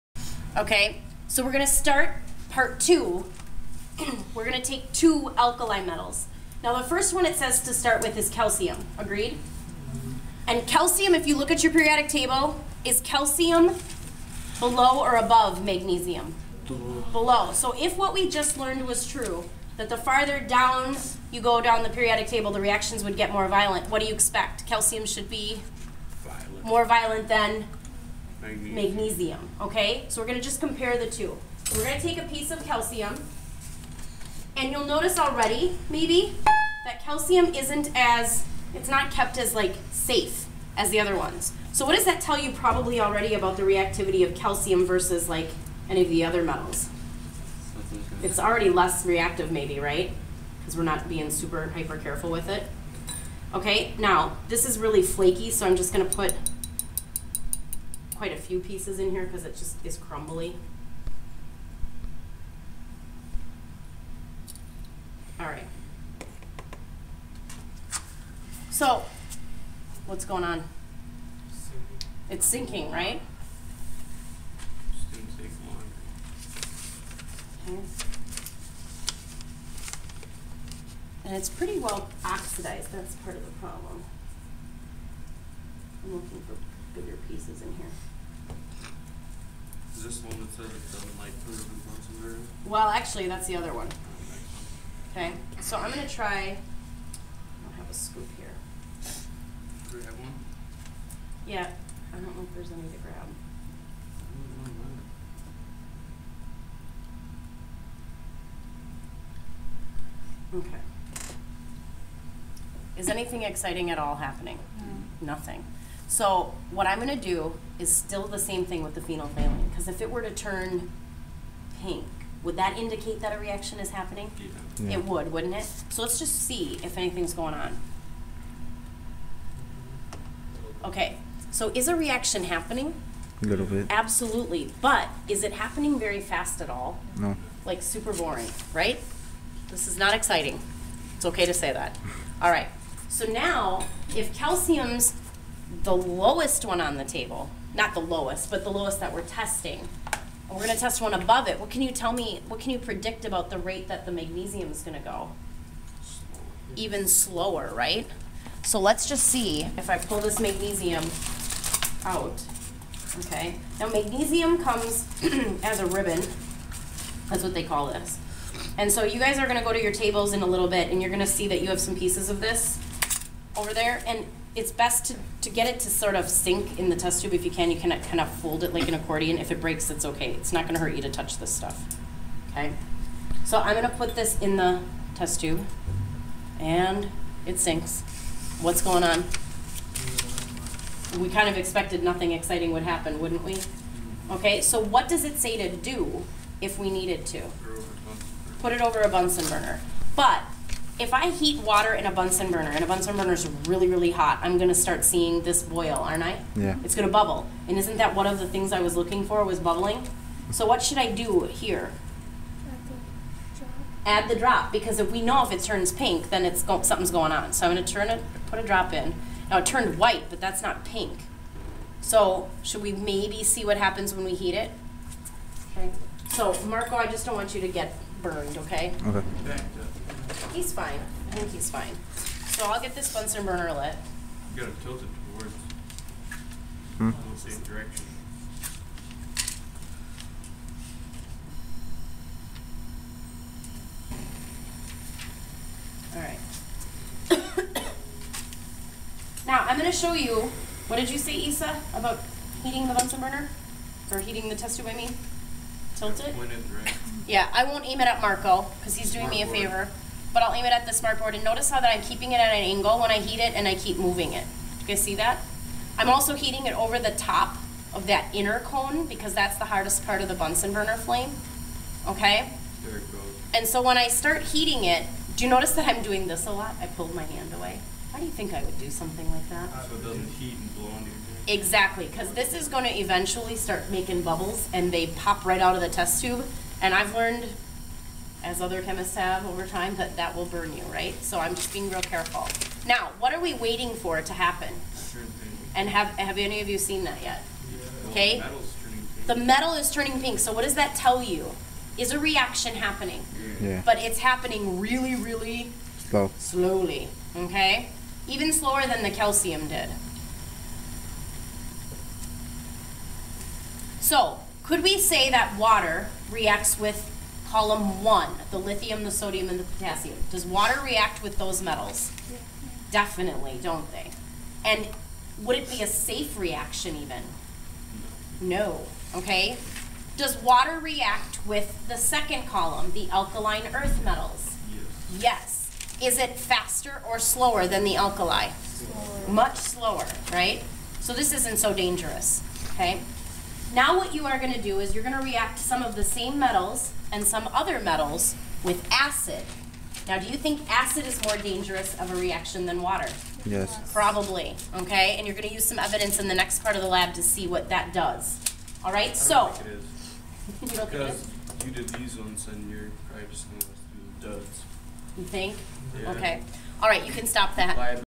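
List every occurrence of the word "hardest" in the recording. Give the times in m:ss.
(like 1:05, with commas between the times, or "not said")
4:29.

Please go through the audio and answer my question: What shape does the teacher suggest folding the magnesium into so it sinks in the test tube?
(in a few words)
an accordion.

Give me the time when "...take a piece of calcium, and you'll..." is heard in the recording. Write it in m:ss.
0:31.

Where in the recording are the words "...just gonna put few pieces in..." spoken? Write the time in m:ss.
0:55.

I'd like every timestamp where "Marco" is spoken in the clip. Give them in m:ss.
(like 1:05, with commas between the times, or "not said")
3:46, 4:18.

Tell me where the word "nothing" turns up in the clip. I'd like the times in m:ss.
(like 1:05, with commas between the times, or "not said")
1:55, 3:12.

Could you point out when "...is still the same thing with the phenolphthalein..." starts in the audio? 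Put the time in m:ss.
1:57.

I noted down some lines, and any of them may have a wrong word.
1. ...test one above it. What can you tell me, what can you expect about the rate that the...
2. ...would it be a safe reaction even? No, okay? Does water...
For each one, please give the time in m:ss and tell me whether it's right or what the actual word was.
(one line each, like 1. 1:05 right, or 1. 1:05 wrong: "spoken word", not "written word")
1. 2:30 wrong: "predict", not "expect"
2. 5:25 right.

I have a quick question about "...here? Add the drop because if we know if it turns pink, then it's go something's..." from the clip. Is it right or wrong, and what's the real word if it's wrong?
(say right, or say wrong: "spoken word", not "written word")
right.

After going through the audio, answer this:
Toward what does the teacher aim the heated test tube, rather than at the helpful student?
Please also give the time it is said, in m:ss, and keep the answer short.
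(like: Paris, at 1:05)
the smart board, at 4:20.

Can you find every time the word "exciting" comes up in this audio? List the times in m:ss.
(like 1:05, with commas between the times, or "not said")
1:53, 2:20, 3:12.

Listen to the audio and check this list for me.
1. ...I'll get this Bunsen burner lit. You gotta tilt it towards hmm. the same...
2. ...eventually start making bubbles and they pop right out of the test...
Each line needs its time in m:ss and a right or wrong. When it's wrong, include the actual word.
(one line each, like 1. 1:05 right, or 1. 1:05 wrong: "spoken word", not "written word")
1. 3:52 right
2. 4:42 right.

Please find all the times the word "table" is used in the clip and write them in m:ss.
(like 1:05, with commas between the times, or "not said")
0:12, 0:22, 2:27, 2:49.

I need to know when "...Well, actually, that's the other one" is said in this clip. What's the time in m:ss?
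1:32.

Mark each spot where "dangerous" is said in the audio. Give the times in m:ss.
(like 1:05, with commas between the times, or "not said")
5:41, 5:51.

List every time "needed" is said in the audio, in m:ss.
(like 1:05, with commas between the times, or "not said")
3:16.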